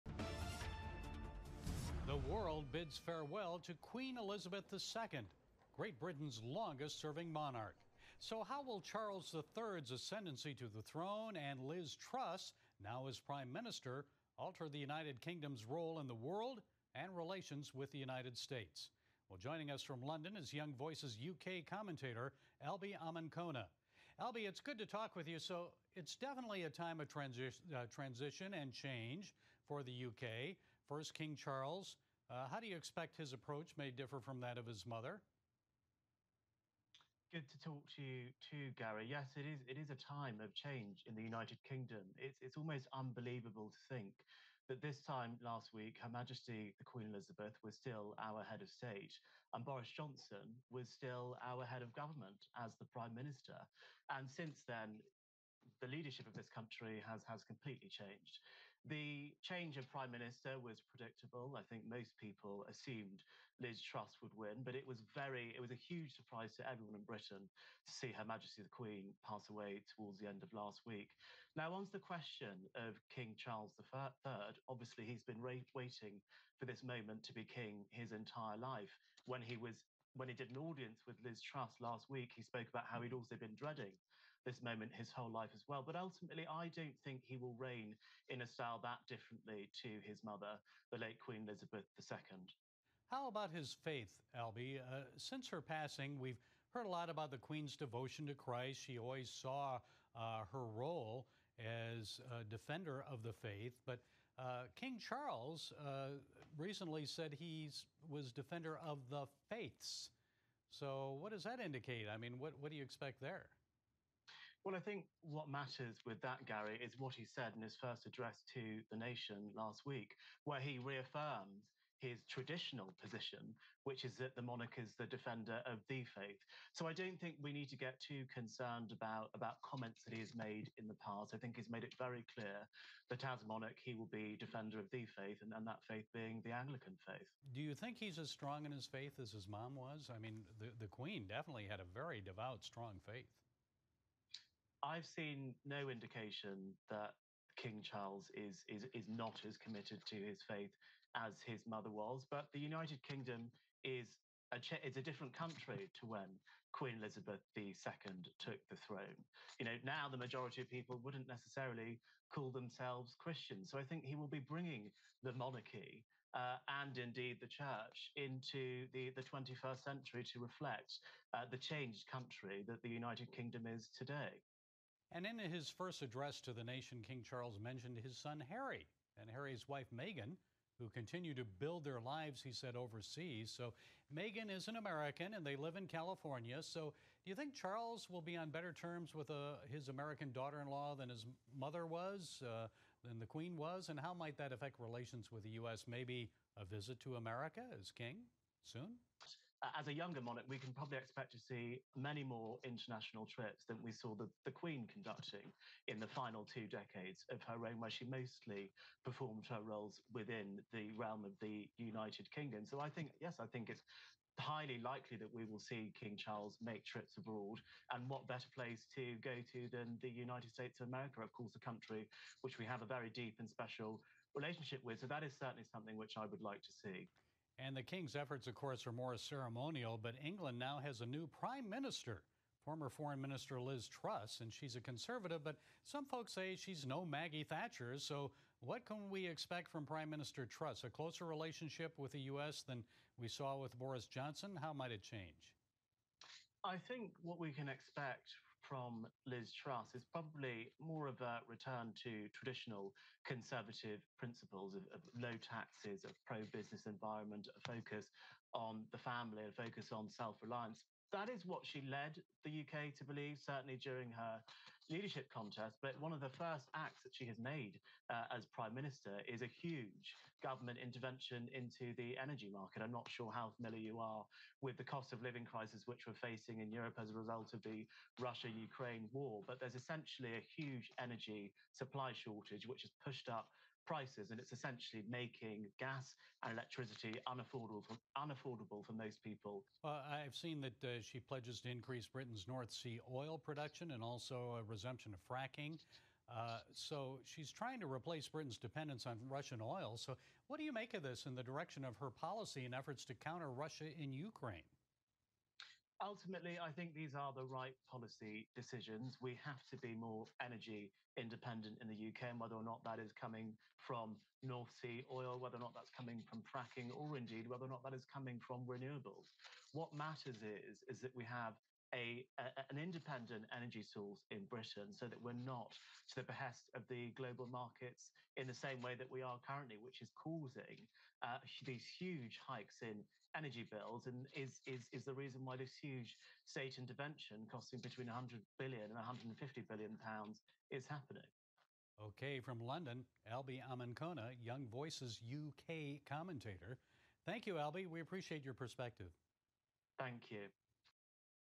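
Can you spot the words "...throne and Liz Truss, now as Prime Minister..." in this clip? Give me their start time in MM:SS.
00:10.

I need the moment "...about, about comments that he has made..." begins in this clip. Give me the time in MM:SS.
02:08.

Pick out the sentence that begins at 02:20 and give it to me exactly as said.
I mean, the, the Queen definitely had a very devout, strong faith.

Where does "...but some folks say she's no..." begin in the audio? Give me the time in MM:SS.
03:55.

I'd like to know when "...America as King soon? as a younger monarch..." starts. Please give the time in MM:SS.
03:17.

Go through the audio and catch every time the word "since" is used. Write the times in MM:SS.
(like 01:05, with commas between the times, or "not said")
00:54, 01:35.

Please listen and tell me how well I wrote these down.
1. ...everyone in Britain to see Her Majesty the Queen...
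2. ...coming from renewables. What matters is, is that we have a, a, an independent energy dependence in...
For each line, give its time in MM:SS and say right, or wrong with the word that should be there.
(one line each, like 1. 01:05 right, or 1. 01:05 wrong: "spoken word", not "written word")
1. 01:06 right
2. 05:18 wrong: "source", not "dependence".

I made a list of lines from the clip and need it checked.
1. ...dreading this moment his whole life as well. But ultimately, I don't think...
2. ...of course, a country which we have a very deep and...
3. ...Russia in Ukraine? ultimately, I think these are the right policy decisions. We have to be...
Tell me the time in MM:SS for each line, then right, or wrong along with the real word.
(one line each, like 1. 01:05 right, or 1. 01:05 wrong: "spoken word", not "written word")
1. 01:23 right
2. 03:41 right
3. 05:03 right.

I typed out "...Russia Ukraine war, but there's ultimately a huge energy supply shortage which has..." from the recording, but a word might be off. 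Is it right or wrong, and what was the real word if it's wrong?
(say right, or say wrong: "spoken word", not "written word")
wrong: "essentially", not "ultimately".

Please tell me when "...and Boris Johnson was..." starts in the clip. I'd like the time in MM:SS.
00:49.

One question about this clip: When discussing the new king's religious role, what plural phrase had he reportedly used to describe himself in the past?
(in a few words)
defender of the faiths.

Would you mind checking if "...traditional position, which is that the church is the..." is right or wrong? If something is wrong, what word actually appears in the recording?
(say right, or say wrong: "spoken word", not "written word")
wrong: "monarch", not "church".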